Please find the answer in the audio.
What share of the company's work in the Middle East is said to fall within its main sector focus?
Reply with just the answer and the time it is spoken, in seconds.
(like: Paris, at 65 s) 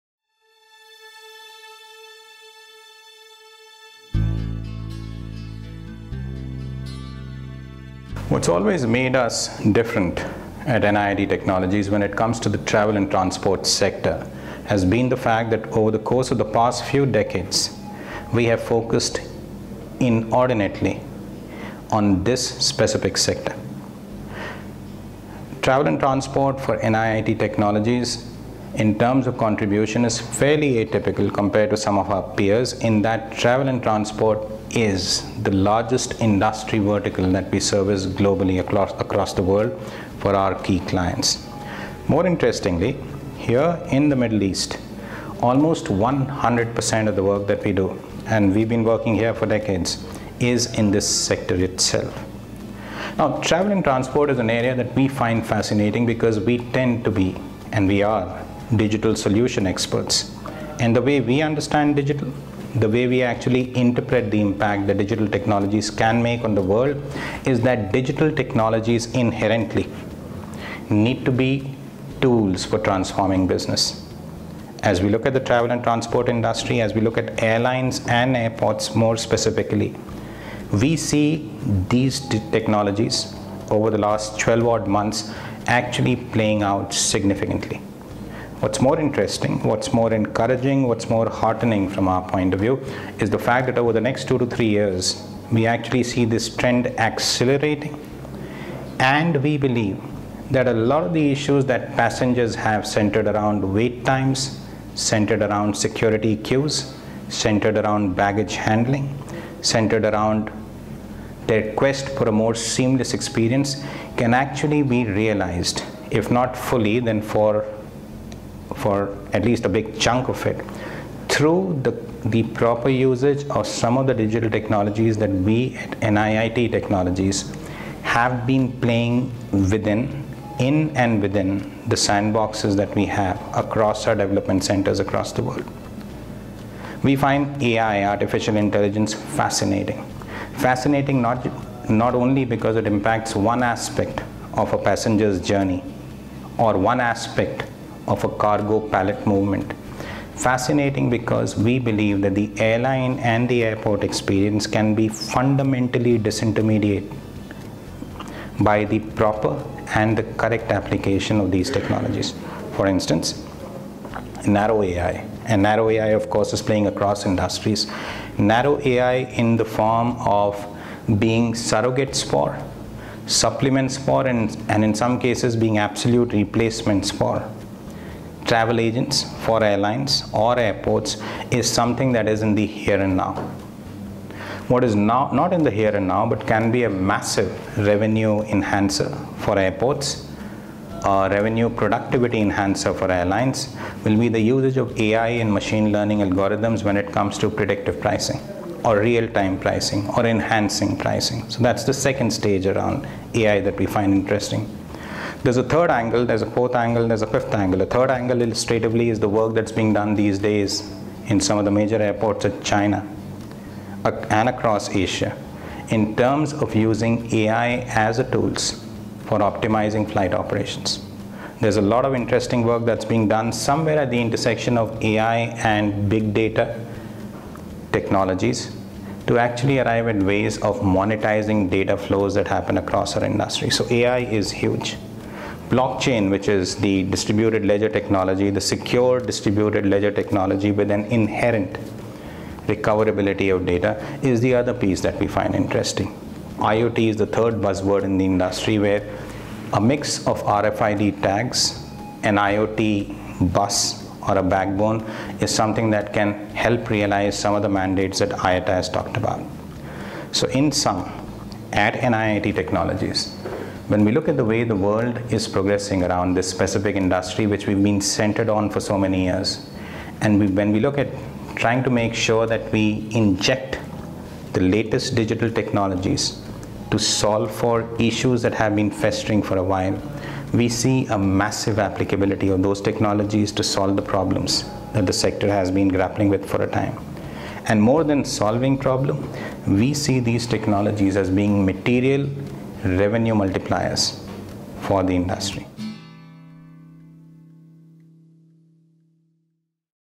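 almost 100%, at 45 s.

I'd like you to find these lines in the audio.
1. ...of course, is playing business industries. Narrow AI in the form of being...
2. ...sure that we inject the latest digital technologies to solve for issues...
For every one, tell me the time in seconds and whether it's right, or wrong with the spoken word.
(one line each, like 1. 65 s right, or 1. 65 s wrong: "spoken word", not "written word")
1. 166 s wrong: "across", not "business"
2. 272 s right.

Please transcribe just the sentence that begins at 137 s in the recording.
We find AI, artificial intelligence, fascinating.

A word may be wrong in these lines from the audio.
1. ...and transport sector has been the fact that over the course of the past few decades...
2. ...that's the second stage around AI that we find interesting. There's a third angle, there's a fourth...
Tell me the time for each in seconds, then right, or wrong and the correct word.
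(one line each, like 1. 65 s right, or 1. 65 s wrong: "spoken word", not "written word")
1. 12 s right
2. 201 s right.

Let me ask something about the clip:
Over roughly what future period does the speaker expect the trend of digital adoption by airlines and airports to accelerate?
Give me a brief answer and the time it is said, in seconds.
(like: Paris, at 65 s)
two to three years, at 94 s.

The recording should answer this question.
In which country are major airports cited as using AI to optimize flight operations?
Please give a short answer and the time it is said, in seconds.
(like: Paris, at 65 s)
China, at 212 s.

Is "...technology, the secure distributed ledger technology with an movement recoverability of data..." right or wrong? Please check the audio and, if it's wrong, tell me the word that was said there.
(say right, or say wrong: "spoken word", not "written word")
wrong: "inherent", not "movement".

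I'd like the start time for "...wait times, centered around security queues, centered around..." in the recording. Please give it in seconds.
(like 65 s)
103 s.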